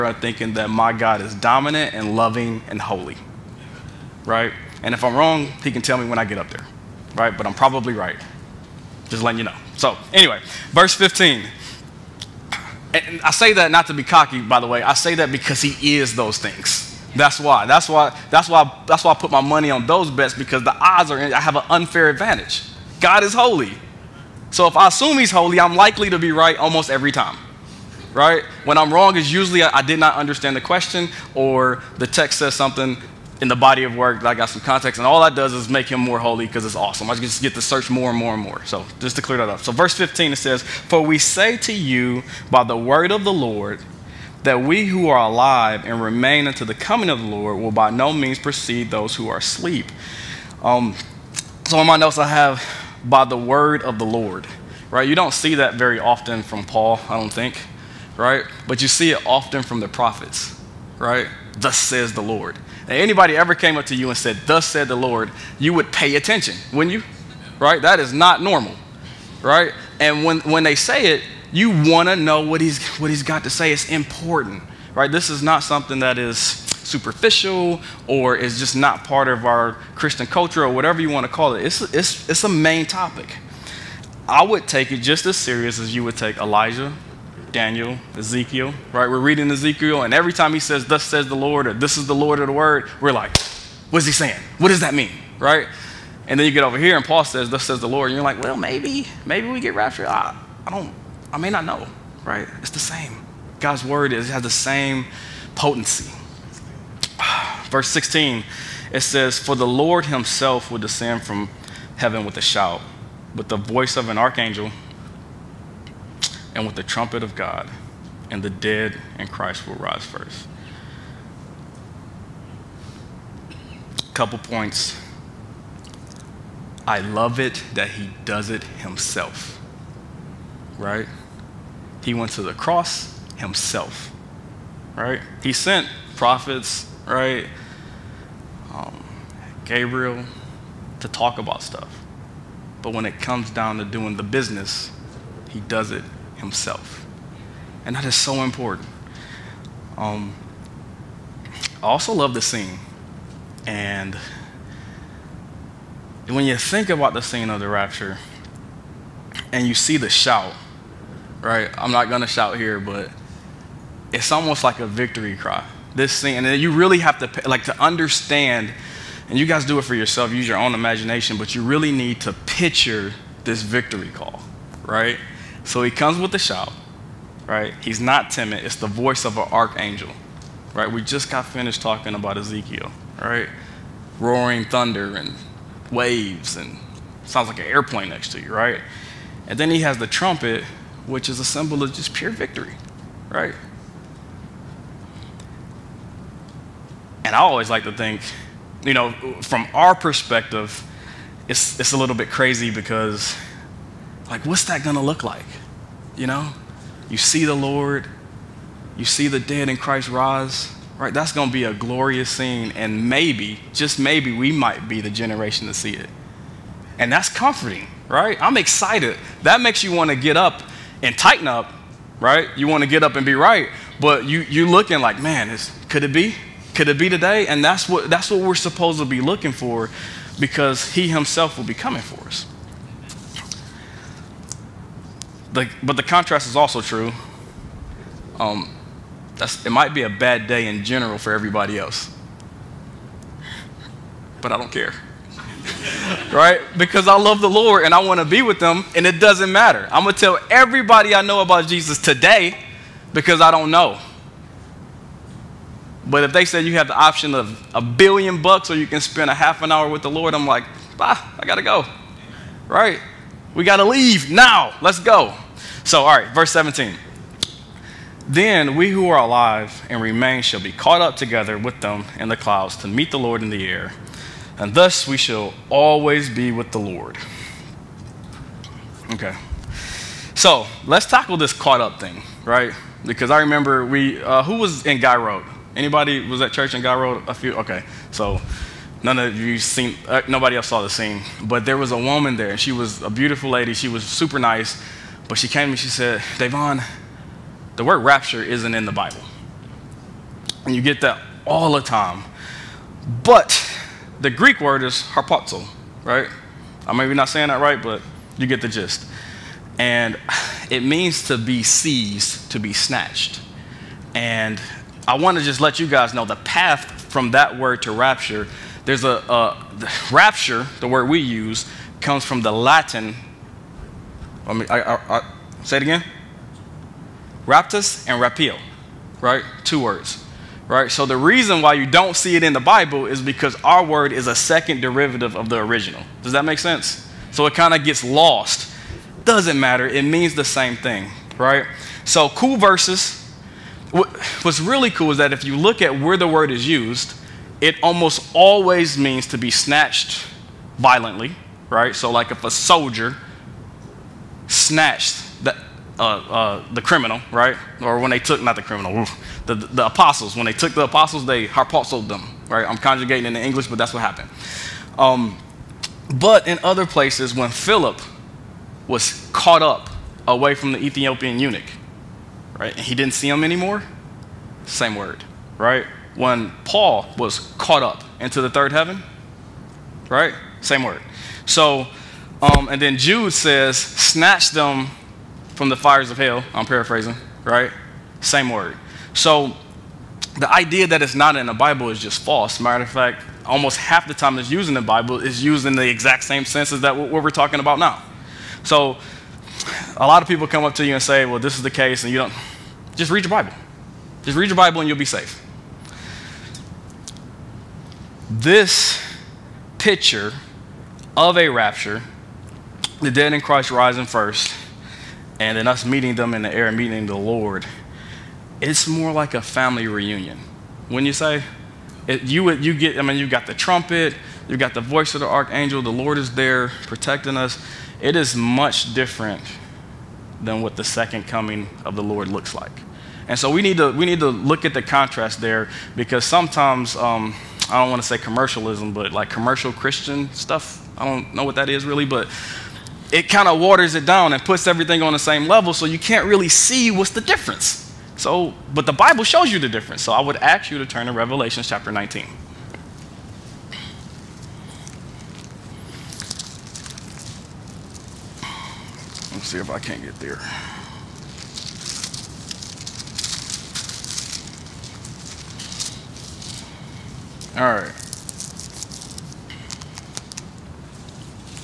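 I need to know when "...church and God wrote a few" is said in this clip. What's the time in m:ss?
4:46.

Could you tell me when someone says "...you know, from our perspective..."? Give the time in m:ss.
3:18.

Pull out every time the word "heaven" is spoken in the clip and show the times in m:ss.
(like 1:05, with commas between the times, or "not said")
1:51, 6:18.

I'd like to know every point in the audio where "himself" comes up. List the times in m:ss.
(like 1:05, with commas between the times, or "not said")
1:50, 2:08, 2:13, 2:26, 3:51.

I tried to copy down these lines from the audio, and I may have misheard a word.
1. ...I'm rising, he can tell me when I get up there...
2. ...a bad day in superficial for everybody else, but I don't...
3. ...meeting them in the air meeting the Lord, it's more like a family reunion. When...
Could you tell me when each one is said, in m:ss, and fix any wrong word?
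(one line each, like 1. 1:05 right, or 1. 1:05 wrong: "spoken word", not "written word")
1. 0:05 wrong: "wrong", not "rising"
2. 4:00 wrong: "general", not "superficial"
3. 6:55 right.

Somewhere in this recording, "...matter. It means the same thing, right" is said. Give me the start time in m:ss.
5:39.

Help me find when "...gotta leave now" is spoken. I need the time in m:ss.
4:23.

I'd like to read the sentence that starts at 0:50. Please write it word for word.
Um, so in my notes I have by the word of the Lord, right?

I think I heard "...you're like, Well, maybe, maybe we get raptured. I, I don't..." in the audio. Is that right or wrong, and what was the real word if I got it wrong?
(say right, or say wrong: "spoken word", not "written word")
right.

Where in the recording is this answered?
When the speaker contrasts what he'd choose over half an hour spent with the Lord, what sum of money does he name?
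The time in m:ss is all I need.
4:17.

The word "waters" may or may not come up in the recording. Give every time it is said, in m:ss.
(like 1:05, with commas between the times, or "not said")
7:23.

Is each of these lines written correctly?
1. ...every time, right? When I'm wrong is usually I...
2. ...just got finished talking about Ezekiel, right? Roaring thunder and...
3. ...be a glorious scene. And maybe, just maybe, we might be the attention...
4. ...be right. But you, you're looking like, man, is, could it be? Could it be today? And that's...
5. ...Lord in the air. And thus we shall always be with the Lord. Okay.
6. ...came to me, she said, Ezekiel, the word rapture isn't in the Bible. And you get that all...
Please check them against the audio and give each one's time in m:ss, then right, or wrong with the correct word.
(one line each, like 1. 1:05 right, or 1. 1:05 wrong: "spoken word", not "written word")
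1. 0:26 right
2. 3:01 right
3. 3:31 wrong: "generation", not "attention"
4. 3:43 right
5. 4:33 right
6. 4:55 wrong: "Davaughn", not "Ezekiel".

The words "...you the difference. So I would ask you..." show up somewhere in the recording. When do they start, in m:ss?
7:29.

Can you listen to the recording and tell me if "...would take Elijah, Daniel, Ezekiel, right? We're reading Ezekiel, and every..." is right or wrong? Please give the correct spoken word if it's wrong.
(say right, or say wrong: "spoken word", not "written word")
right.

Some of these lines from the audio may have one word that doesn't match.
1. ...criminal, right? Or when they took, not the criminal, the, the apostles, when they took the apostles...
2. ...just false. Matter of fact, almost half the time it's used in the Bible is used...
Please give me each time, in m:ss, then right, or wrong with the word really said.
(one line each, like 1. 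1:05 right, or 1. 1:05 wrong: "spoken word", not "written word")
1. 5:56 right
2. 6:31 right.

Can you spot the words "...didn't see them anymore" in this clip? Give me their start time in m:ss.
6:12.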